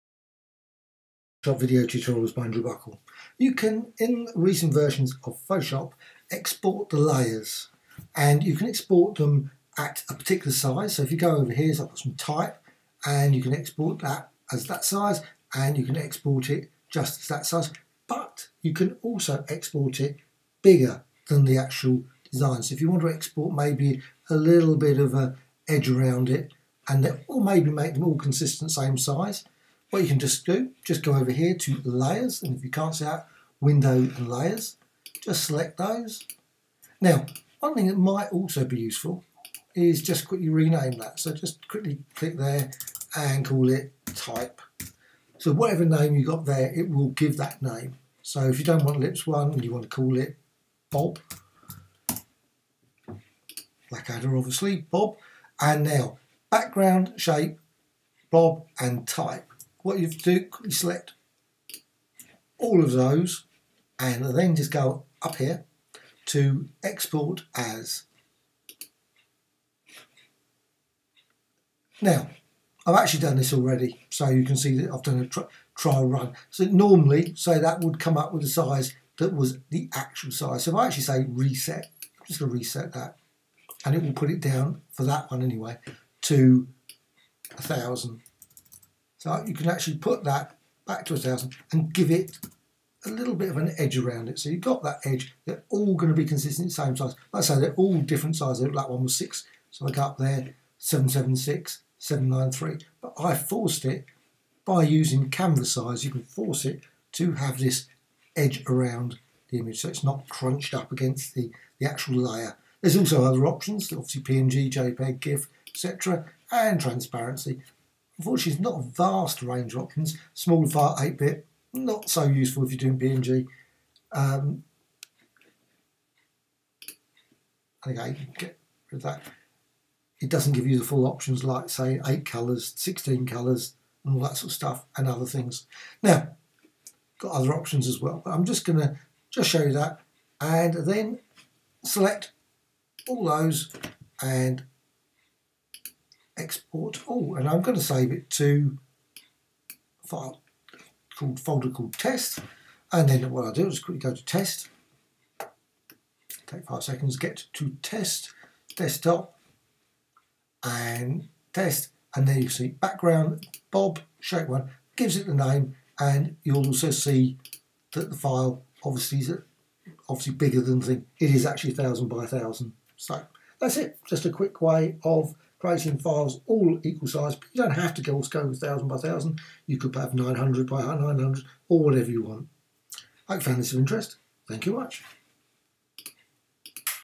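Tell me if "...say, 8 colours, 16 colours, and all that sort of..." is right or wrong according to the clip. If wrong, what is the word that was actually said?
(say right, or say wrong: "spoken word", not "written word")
right.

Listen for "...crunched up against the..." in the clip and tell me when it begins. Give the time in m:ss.
1:50.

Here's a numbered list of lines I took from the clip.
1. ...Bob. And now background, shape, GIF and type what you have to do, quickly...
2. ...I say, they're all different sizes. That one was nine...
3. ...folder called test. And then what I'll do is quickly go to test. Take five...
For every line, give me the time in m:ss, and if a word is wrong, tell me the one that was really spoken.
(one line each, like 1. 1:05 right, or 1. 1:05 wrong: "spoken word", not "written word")
1. 0:54 wrong: "Bob", not "GIF"
2. 1:37 wrong: "six", not "nine"
3. 2:31 right.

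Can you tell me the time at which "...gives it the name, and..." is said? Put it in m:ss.
2:44.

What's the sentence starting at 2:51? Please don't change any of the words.
It is actually 1000 by 1000.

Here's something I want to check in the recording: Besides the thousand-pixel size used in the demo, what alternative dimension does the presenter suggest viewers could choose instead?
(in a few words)
900 by 900.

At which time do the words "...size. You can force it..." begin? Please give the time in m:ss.
1:45.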